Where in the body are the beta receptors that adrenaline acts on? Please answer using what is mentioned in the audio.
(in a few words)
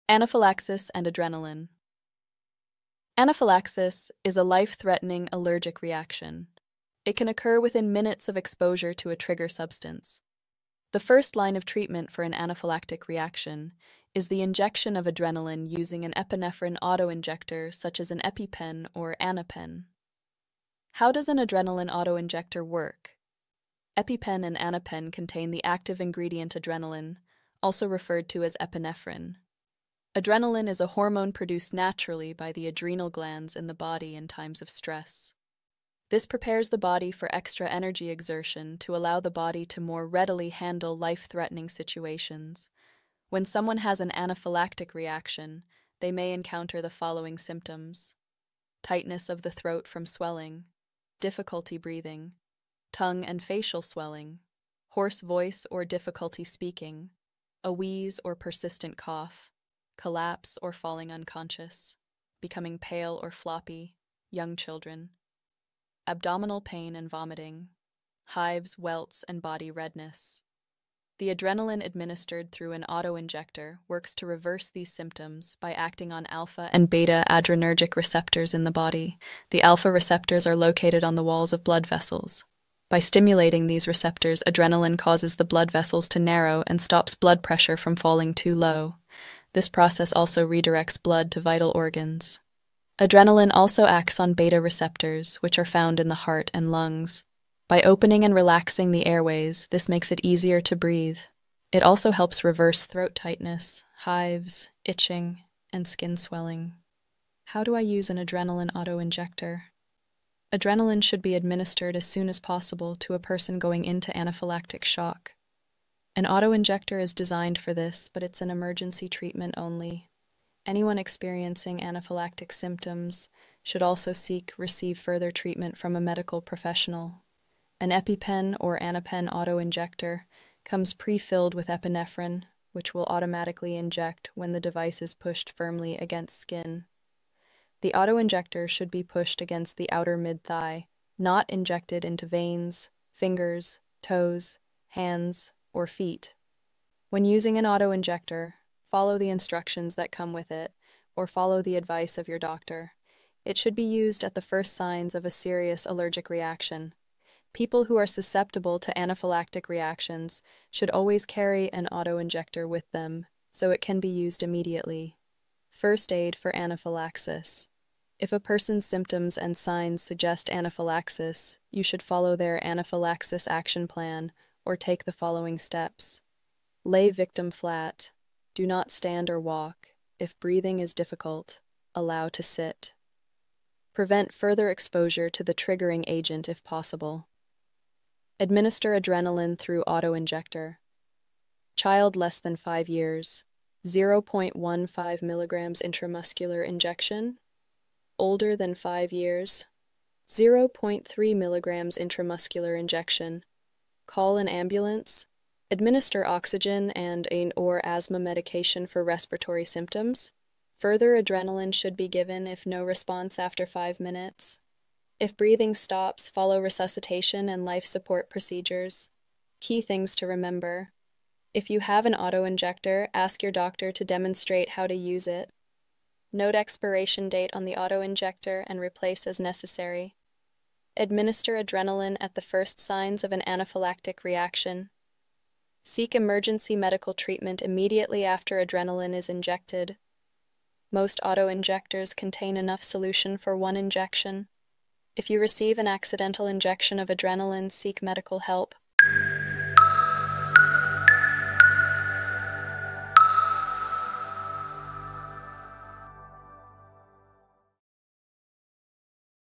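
Heart and lungs.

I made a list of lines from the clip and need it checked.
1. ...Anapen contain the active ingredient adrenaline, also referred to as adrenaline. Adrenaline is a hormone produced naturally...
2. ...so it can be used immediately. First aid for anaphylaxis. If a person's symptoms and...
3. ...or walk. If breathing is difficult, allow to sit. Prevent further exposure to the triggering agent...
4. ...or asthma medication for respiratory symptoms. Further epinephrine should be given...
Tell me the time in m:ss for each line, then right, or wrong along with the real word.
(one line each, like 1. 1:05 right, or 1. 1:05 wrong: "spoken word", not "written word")
1. 0:24 wrong: "epinephrine", not "adrenaline"
2. 2:43 right
3. 2:59 right
4. 3:27 wrong: "adrenaline", not "epinephrine".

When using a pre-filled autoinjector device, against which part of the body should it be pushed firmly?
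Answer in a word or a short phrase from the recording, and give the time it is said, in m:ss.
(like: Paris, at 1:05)
Outer mid-thigh, at 2:19.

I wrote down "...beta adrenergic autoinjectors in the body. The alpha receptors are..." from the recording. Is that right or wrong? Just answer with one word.
wrong.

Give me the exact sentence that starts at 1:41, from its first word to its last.
It also helps reverse throat tightness, hives, itching, and skin swelling.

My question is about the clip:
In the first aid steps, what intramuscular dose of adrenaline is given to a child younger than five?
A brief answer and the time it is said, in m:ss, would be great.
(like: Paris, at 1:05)
0.15 milligrams, at 3:13.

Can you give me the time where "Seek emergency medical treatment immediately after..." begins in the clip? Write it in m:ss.
3:55.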